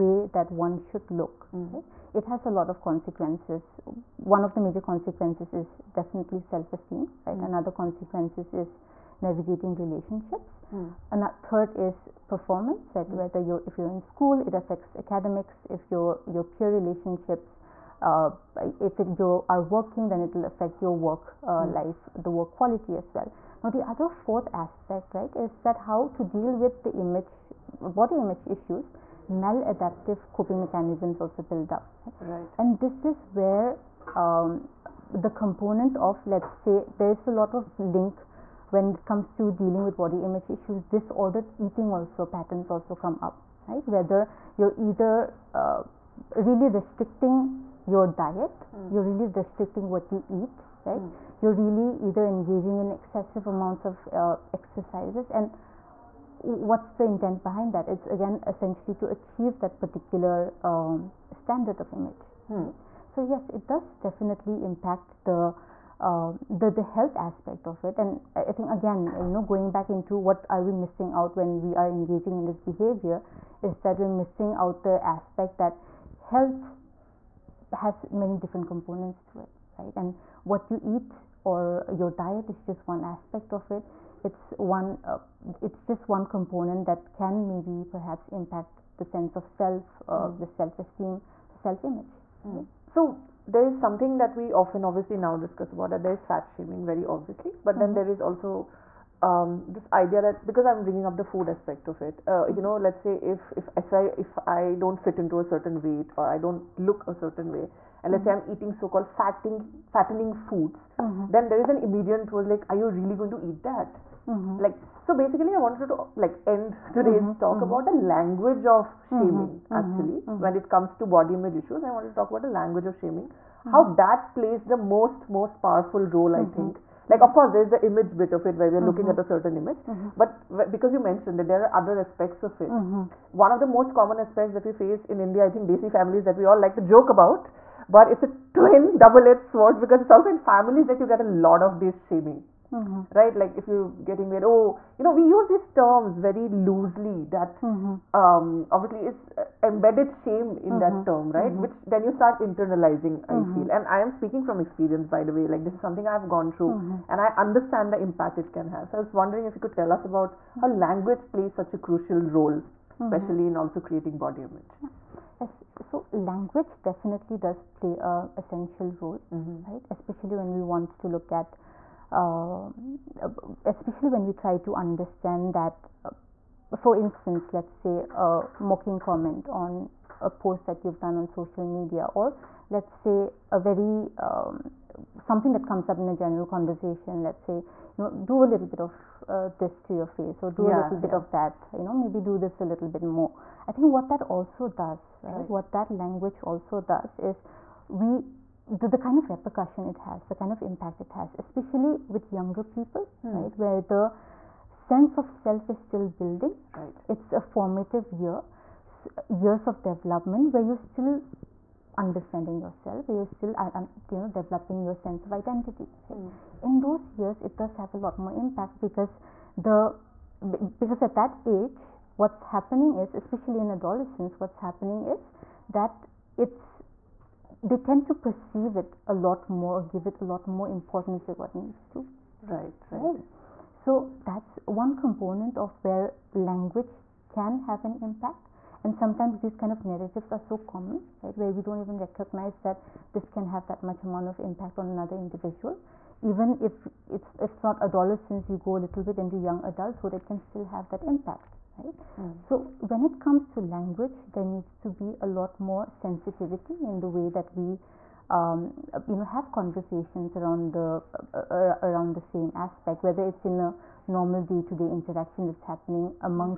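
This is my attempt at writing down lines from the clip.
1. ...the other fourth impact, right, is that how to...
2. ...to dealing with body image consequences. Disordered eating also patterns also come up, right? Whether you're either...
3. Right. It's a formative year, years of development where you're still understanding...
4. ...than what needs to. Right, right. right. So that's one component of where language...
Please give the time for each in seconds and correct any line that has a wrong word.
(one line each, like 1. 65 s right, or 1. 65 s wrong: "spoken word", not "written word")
1. 23 s wrong: "aspect", not "impact"
2. 39 s wrong: "issues", not "consequences"
3. 206 s right
4. 231 s right.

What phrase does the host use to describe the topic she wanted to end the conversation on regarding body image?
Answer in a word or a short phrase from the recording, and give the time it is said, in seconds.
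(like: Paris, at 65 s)
The language of shaming, at 122 s.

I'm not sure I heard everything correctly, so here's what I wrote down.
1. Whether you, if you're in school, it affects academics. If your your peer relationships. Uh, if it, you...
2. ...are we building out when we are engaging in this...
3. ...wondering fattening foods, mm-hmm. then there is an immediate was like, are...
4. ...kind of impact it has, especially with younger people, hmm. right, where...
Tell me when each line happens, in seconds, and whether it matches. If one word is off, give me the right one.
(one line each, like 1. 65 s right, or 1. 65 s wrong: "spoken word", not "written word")
1. 13 s right
2. 70 s wrong: "missing", not "building"
3. 109 s wrong: "fattening", not "wondering"
4. 200 s right.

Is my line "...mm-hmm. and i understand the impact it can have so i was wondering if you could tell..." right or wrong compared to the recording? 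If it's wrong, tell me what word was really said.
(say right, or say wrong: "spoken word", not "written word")
right.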